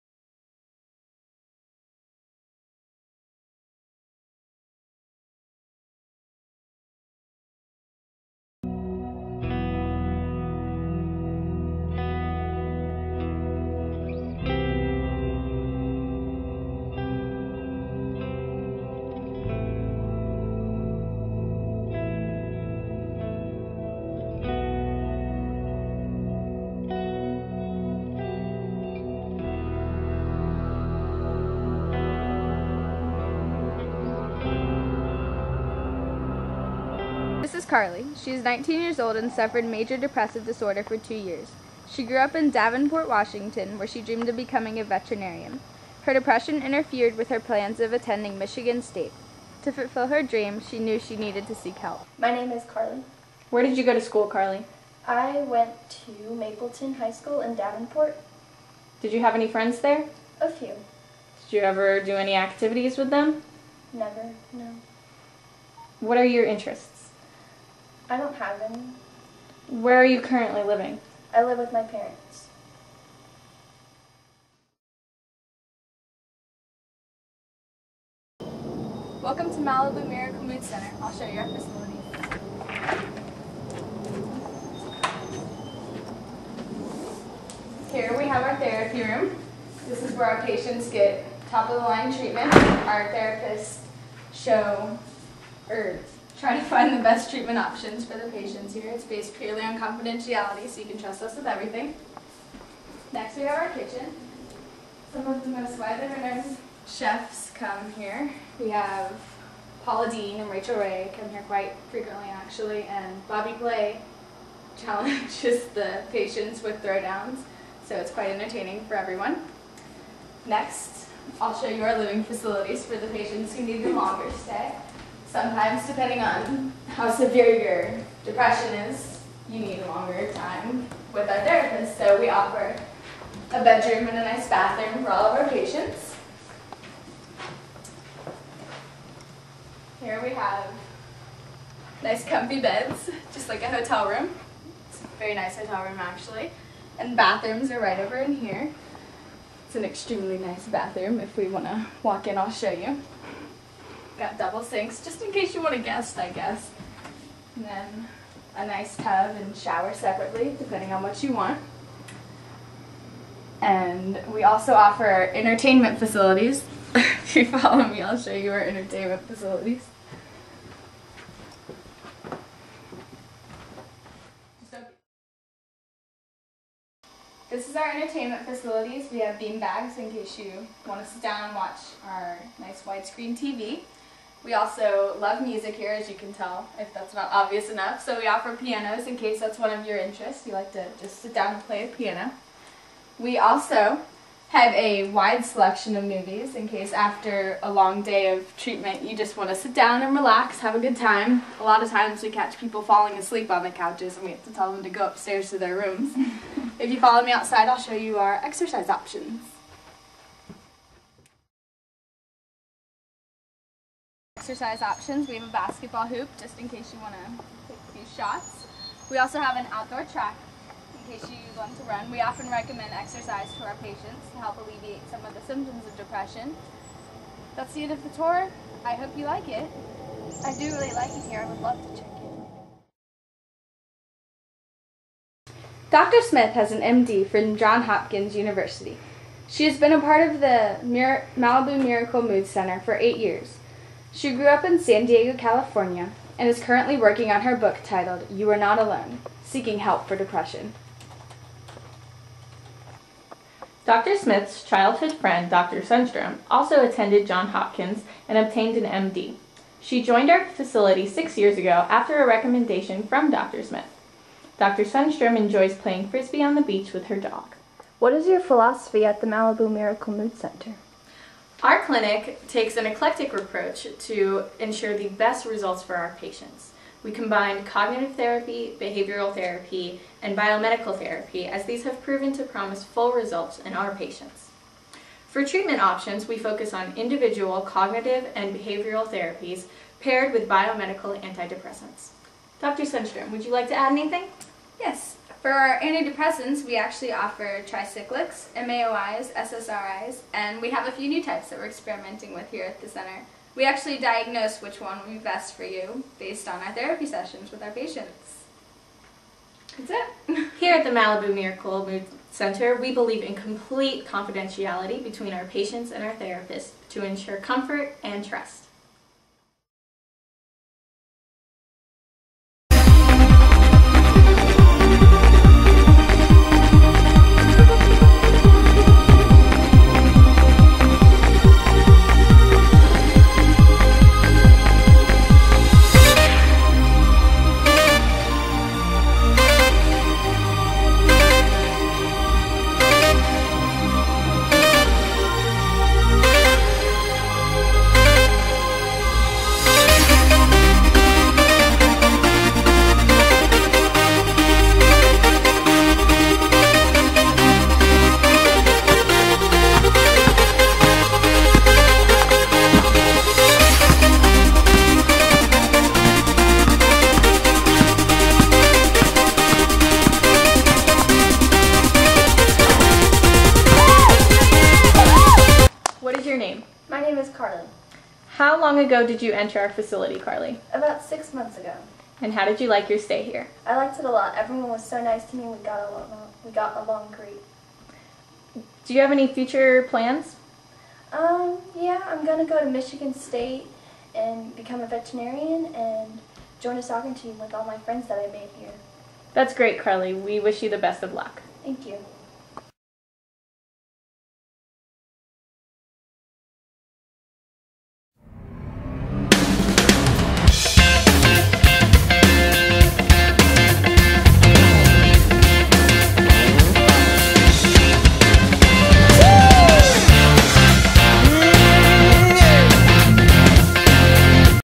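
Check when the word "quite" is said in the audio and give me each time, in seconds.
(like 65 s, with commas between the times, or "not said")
111 s, 118 s.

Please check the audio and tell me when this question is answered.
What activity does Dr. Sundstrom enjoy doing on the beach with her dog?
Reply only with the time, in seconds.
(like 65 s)
265 s.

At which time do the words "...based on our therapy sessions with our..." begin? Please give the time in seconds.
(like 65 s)
306 s.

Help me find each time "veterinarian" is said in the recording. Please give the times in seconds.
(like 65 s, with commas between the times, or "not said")
44 s, 394 s.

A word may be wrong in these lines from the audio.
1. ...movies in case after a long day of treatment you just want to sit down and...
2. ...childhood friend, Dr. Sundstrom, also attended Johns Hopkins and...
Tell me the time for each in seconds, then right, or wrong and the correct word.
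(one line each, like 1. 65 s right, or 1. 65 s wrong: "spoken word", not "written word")
1. 196 s right
2. 254 s right.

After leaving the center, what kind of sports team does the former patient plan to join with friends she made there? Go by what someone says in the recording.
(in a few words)
Soccer team.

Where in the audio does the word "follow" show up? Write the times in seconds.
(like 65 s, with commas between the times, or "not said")
167 s, 206 s.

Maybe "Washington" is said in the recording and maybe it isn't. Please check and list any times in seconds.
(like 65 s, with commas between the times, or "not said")
43 s.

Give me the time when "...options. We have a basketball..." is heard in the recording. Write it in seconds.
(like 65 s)
214 s.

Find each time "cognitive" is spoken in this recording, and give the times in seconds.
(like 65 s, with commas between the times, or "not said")
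277 s, 287 s.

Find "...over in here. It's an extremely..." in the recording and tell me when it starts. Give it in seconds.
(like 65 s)
147 s.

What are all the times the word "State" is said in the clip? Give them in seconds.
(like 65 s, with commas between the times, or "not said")
48 s, 393 s.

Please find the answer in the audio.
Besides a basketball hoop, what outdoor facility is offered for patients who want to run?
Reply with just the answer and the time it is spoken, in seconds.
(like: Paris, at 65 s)
Outdoor track, at 219 s.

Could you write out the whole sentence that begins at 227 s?
That's the end of the tour.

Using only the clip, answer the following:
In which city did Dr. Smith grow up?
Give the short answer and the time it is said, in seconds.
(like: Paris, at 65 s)
San Diego, at 244 s.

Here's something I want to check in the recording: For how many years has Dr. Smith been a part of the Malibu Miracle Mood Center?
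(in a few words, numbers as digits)
8.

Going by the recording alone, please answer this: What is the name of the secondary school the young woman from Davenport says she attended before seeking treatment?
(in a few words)
Mapleton High School.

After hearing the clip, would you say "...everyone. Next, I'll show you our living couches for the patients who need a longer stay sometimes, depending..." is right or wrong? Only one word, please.
wrong.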